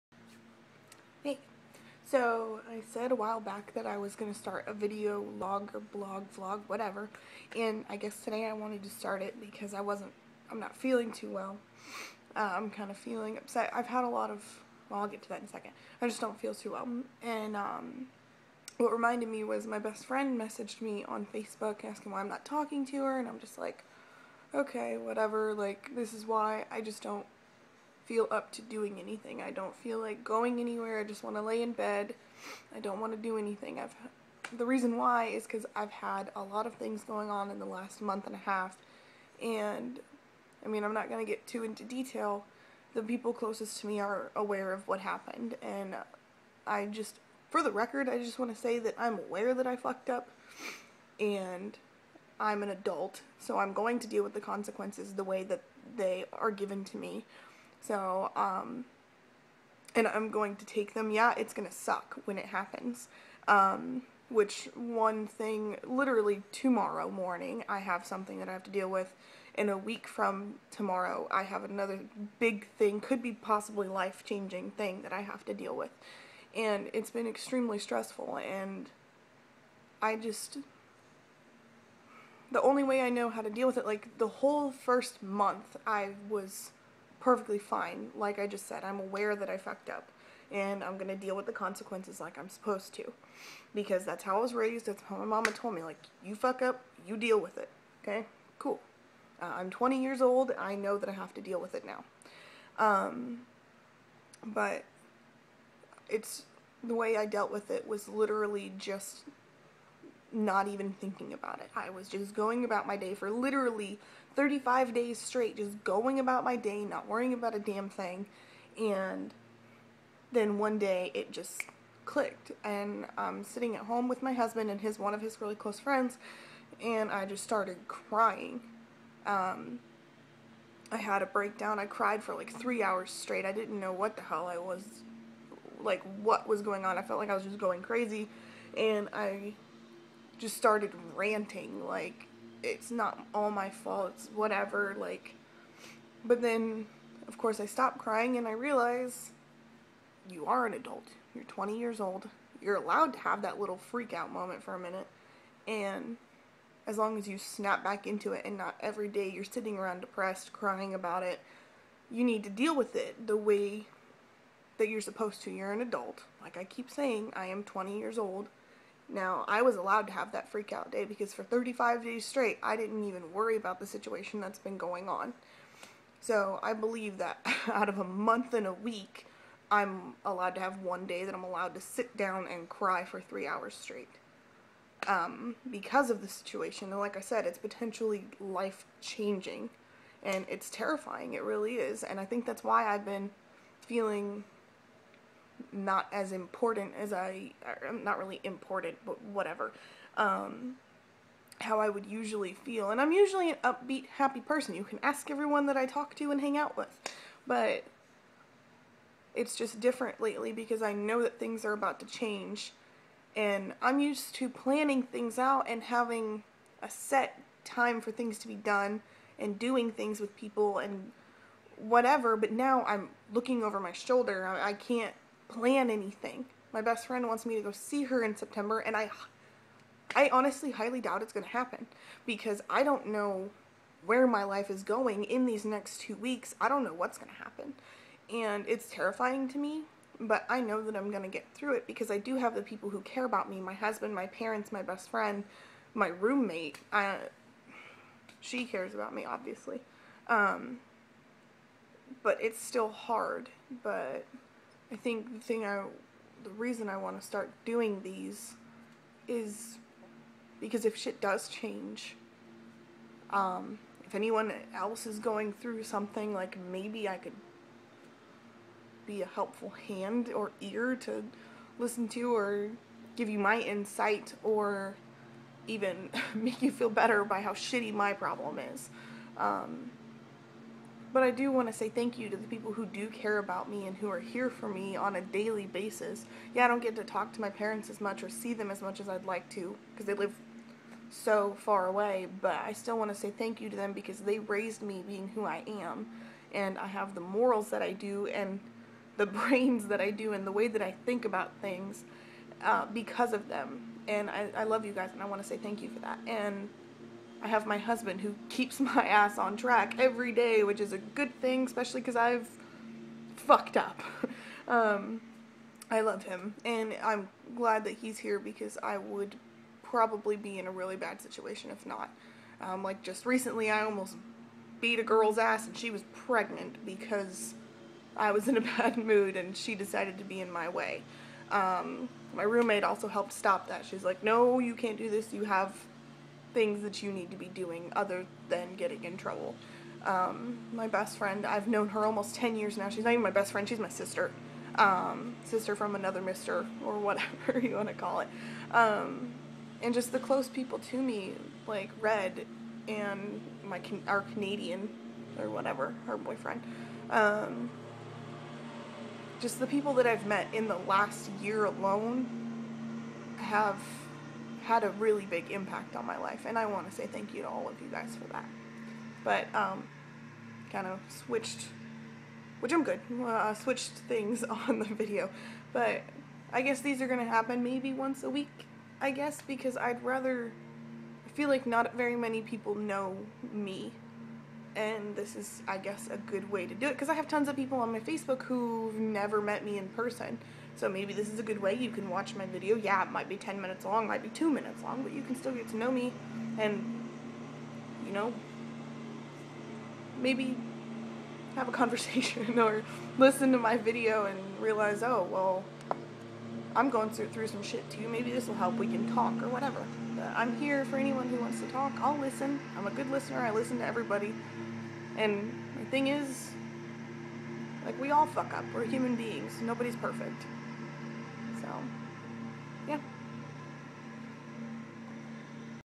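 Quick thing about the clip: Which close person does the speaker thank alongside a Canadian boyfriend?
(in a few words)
Red.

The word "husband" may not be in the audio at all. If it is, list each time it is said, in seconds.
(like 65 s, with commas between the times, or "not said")
124 s, 243 s, 307 s.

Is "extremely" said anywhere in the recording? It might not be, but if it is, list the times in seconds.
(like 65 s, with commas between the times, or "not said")
77 s.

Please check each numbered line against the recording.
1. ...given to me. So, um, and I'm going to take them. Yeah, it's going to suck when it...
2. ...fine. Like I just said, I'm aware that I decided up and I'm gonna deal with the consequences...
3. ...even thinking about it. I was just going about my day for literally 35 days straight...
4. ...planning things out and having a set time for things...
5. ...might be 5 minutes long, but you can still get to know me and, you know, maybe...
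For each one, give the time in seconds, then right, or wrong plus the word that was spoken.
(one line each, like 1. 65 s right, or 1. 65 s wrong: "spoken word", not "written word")
1. 56 s right
2. 87 s wrong: "fucked", not "decided"
3. 110 s right
4. 214 s right
5. 394 s wrong: "2", not "5".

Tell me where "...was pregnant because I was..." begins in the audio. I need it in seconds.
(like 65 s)
325 s.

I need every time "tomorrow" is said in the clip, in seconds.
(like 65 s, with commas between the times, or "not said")
66 s, 70 s.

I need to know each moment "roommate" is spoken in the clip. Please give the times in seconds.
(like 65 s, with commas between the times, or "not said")
246 s, 332 s.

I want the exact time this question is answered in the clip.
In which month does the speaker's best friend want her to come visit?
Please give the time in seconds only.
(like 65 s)
228 s.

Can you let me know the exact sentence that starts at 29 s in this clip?
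I don't feel like going anywhere.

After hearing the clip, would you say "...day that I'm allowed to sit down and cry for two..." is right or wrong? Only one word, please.
wrong.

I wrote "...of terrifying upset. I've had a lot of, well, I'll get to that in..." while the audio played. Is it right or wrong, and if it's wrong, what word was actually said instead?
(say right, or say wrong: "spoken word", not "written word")
wrong: "feeling", not "terrifying".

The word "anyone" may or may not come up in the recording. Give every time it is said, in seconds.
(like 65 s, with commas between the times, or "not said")
264 s, 410 s.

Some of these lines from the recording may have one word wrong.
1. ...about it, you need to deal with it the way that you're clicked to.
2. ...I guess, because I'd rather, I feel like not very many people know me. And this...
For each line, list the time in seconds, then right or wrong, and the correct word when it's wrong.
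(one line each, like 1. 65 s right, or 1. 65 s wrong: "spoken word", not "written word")
1. 160 s wrong: "supposed", not "clicked"
2. 379 s right.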